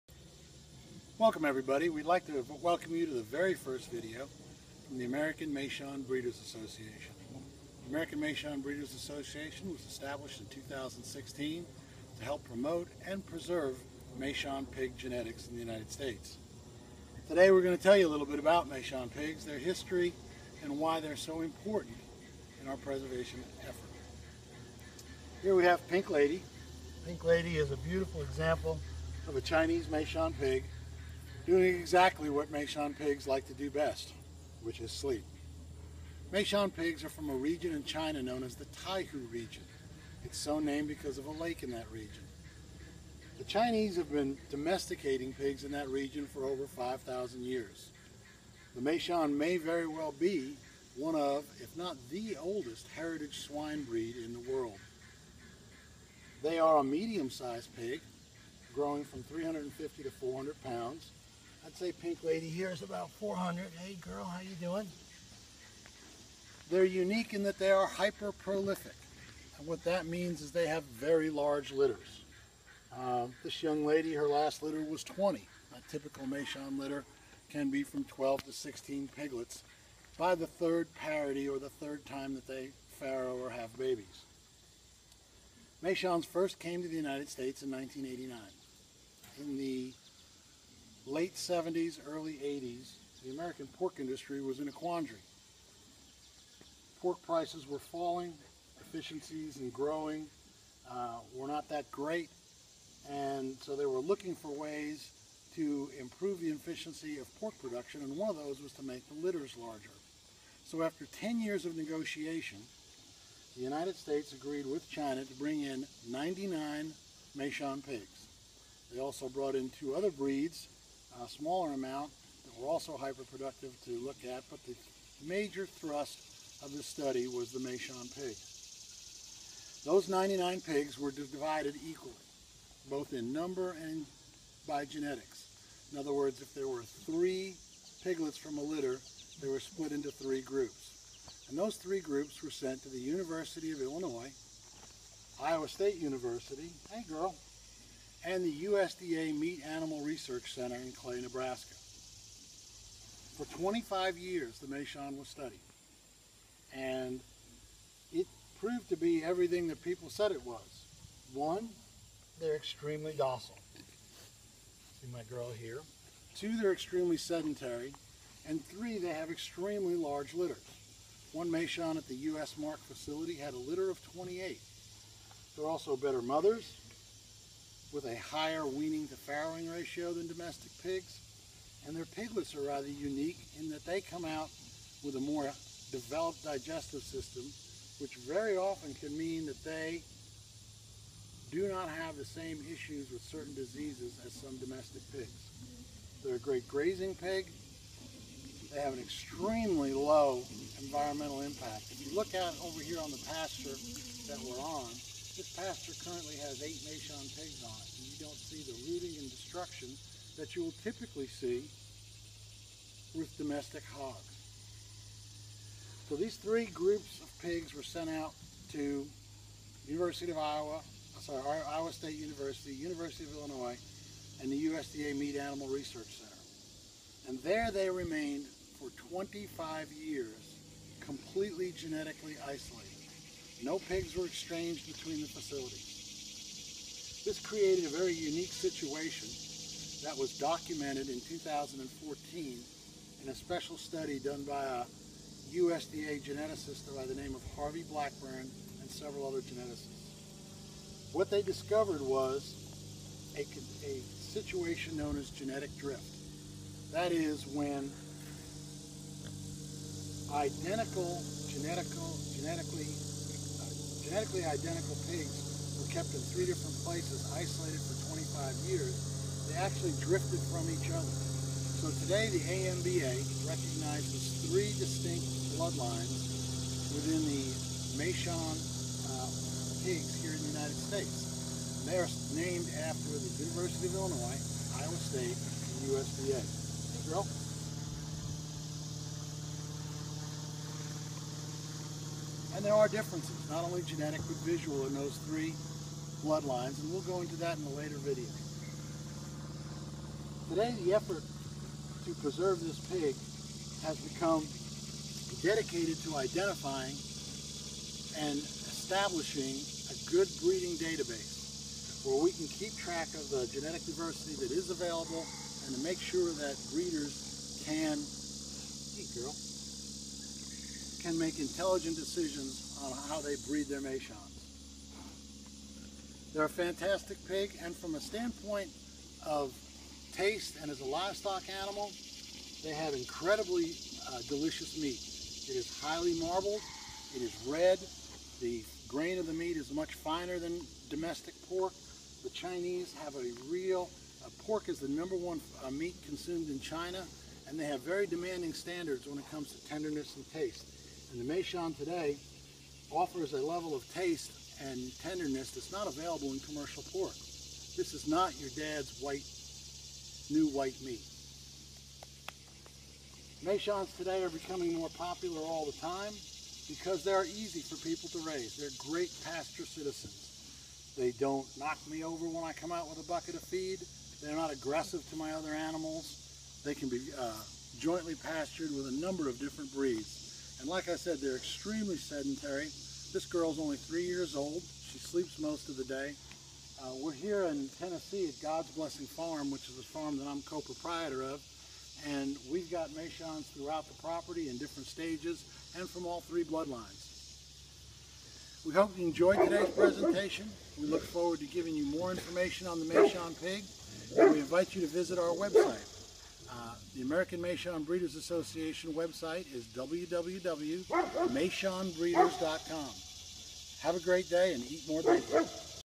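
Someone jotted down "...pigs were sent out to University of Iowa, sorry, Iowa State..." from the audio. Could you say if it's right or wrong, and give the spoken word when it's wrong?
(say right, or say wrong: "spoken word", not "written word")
right.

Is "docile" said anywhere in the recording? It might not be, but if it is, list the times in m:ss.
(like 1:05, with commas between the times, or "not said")
2:43.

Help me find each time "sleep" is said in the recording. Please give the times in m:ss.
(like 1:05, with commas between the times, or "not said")
0:34, 6:24.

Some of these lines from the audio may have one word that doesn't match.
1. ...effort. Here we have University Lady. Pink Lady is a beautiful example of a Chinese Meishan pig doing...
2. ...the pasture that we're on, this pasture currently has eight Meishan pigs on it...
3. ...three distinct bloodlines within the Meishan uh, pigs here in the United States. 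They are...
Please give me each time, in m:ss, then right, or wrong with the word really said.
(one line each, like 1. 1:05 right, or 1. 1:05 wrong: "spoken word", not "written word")
1. 0:23 wrong: "Pink", not "University"
2. 3:23 right
3. 4:34 right.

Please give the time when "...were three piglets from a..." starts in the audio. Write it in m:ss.
2:16.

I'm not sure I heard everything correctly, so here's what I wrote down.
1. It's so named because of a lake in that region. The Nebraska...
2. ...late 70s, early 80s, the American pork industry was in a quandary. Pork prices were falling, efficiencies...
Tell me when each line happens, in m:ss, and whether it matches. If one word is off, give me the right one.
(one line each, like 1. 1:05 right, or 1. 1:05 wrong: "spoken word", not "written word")
1. 0:40 wrong: "Chinese", not "Nebraska"
2. 1:31 right.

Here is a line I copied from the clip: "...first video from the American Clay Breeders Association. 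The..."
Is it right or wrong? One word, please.
wrong.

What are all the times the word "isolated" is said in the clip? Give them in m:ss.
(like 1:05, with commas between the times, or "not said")
3:52, 4:27.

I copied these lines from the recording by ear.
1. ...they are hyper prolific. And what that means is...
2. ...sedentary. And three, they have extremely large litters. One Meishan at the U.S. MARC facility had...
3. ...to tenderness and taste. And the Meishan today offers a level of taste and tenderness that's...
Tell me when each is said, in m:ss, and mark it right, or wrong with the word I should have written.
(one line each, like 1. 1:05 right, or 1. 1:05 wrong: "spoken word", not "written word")
1. 1:07 right
2. 2:47 right
3. 5:49 right.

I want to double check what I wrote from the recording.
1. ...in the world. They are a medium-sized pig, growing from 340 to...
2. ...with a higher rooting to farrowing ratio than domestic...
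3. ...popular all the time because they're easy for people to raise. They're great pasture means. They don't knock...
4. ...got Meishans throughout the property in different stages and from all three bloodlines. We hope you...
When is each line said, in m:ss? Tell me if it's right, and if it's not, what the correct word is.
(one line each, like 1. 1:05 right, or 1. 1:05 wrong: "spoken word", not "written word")
1. 0:54 wrong: "350", not "340"
2. 2:57 wrong: "weaning", not "rooting"
3. 6:04 wrong: "citizens", not "means"
4. 6:32 right.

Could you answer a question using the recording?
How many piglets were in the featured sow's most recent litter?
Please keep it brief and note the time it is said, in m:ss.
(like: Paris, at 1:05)
20, at 1:15.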